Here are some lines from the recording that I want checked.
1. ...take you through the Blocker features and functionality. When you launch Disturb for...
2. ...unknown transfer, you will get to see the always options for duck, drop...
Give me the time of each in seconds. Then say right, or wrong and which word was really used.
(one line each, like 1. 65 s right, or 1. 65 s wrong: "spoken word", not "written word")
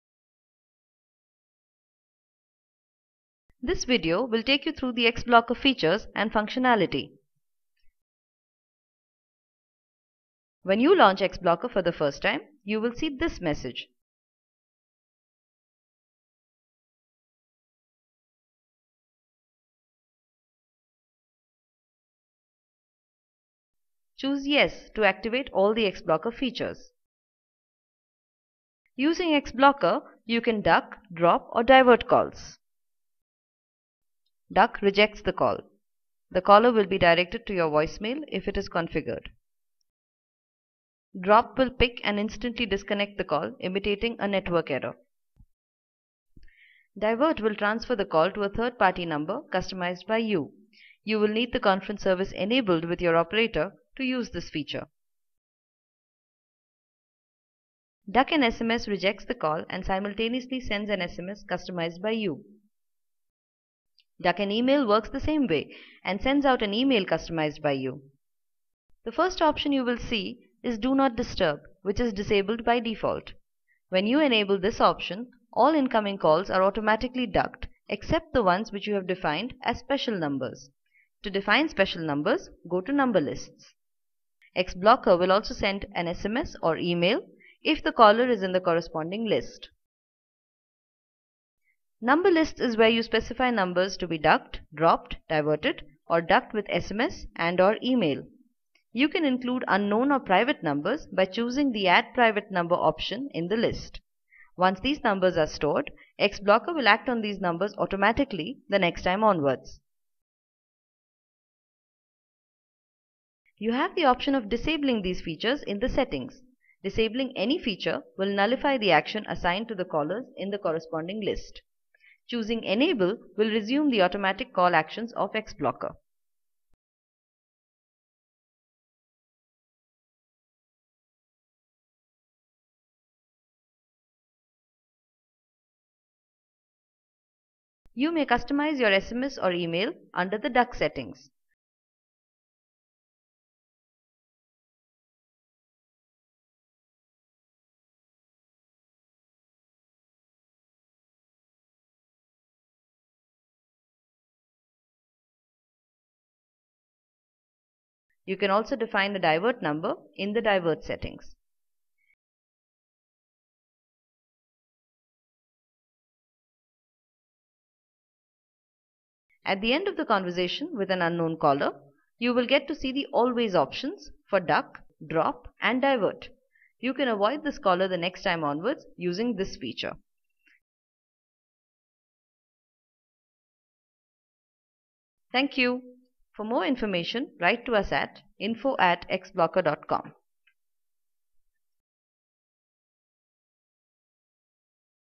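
1. 4 s wrong: "XBLOCKR", not "Disturb"
2. 171 s wrong: "caller", not "transfer".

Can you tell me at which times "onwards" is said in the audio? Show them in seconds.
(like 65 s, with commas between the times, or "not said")
109 s, 178 s.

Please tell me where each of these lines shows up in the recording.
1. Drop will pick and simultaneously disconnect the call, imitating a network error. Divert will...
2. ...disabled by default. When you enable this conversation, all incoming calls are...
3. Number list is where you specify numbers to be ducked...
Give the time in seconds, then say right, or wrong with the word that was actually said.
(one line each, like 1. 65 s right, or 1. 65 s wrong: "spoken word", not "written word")
1. 41 s wrong: "instantly", not "simultaneously"
2. 72 s wrong: "option", not "conversation"
3. 92 s right.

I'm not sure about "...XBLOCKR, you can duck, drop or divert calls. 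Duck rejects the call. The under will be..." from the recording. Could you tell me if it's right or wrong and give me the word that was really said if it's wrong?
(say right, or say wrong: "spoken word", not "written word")
wrong: "caller", not "under".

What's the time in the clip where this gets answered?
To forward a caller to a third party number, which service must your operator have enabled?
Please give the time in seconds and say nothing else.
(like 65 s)
51 s.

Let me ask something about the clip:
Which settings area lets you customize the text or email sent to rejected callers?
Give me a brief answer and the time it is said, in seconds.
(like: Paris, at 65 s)
Duck settings, at 140 s.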